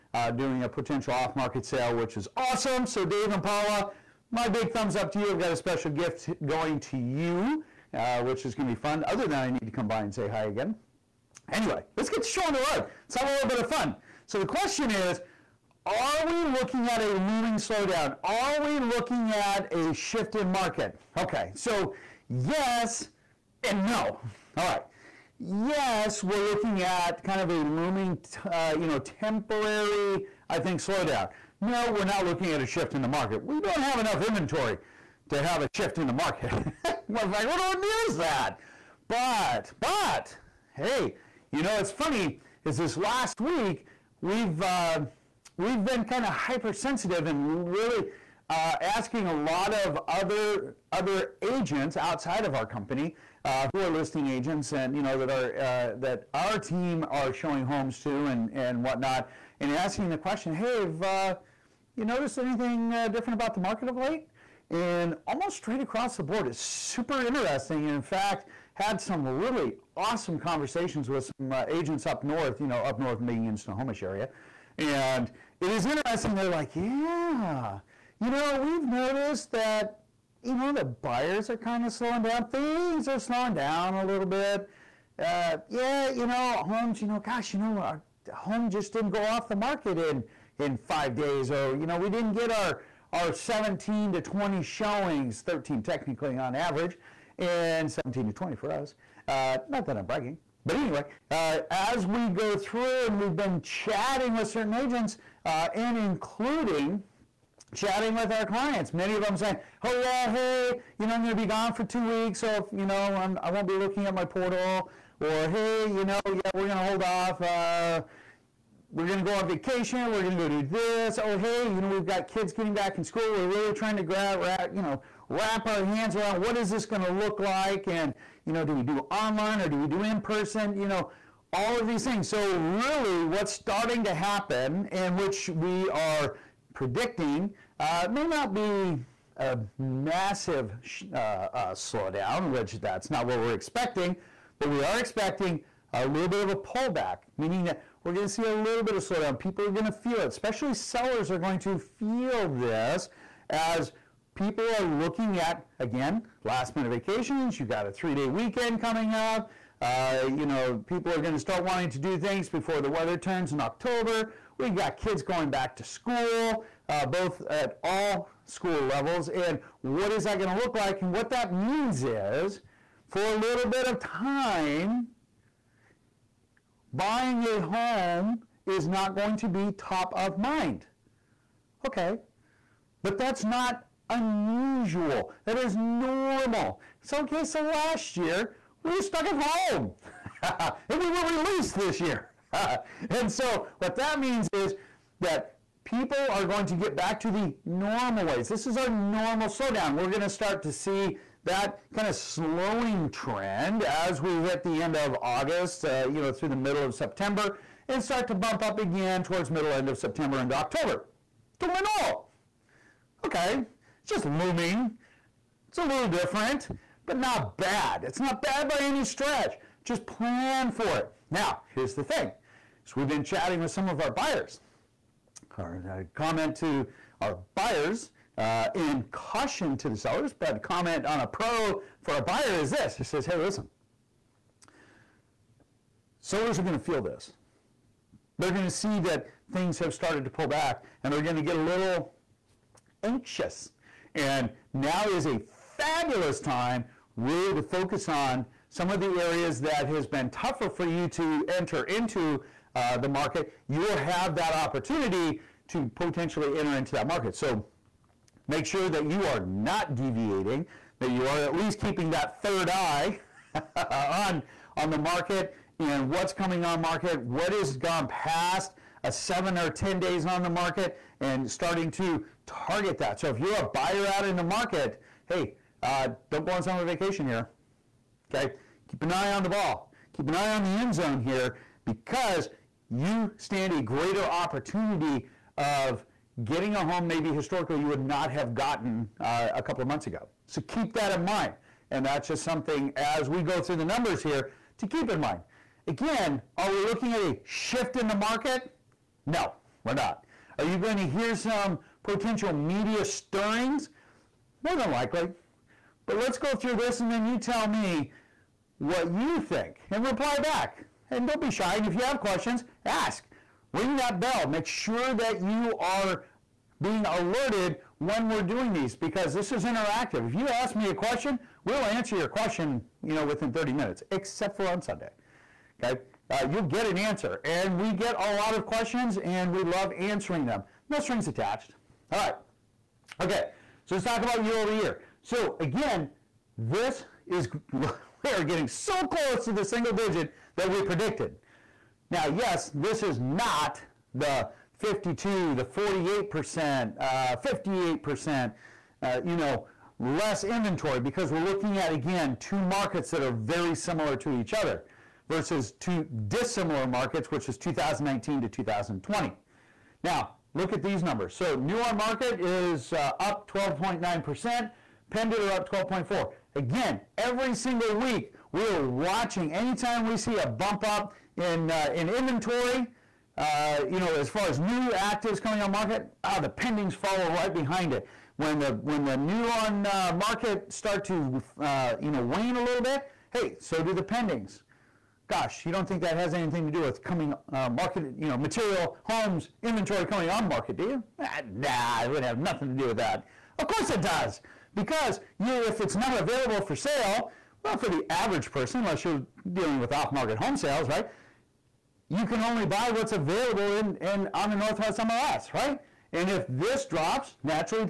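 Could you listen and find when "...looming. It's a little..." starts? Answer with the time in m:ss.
3:34.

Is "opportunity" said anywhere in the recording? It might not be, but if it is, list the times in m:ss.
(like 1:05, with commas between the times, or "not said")
4:14, 4:44.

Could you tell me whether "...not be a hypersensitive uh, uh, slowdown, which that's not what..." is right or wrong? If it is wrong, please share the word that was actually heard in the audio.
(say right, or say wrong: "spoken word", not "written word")
wrong: "massive", not "hypersensitive".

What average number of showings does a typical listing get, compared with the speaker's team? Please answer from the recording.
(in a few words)
13.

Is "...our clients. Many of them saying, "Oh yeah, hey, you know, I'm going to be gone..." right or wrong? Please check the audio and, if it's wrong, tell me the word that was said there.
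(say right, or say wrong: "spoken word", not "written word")
right.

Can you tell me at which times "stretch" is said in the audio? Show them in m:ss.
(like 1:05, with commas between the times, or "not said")
3:39.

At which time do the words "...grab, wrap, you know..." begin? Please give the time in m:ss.
2:04.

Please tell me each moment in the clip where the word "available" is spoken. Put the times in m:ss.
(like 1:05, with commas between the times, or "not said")
6:36, 6:43.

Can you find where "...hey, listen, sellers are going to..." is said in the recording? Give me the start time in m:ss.
3:53.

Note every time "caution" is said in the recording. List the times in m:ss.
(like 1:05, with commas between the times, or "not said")
3:49.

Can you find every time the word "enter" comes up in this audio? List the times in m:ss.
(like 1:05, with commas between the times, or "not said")
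4:11, 4:16.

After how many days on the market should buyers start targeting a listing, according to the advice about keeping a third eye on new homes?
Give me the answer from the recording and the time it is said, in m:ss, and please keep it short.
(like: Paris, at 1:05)
7 or 10 days, at 4:29.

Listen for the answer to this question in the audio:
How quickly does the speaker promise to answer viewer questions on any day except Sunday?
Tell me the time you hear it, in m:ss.
5:23.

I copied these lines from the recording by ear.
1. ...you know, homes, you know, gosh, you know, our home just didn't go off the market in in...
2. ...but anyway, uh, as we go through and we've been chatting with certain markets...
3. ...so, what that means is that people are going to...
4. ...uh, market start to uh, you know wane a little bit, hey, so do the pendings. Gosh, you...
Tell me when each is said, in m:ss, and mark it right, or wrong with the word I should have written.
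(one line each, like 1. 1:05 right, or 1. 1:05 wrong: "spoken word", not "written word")
1. 1:26 right
2. 1:40 wrong: "agents", not "markets"
3. 3:13 right
4. 6:19 right.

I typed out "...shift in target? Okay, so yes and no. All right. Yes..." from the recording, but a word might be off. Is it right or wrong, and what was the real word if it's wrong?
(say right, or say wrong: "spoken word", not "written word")
wrong: "market", not "target".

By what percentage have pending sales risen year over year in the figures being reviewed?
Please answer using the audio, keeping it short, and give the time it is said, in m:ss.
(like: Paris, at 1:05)
12.4%, at 6:05.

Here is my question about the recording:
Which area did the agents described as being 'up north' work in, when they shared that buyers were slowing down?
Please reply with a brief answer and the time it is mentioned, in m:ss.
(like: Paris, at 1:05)
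Snohomish, at 1:13.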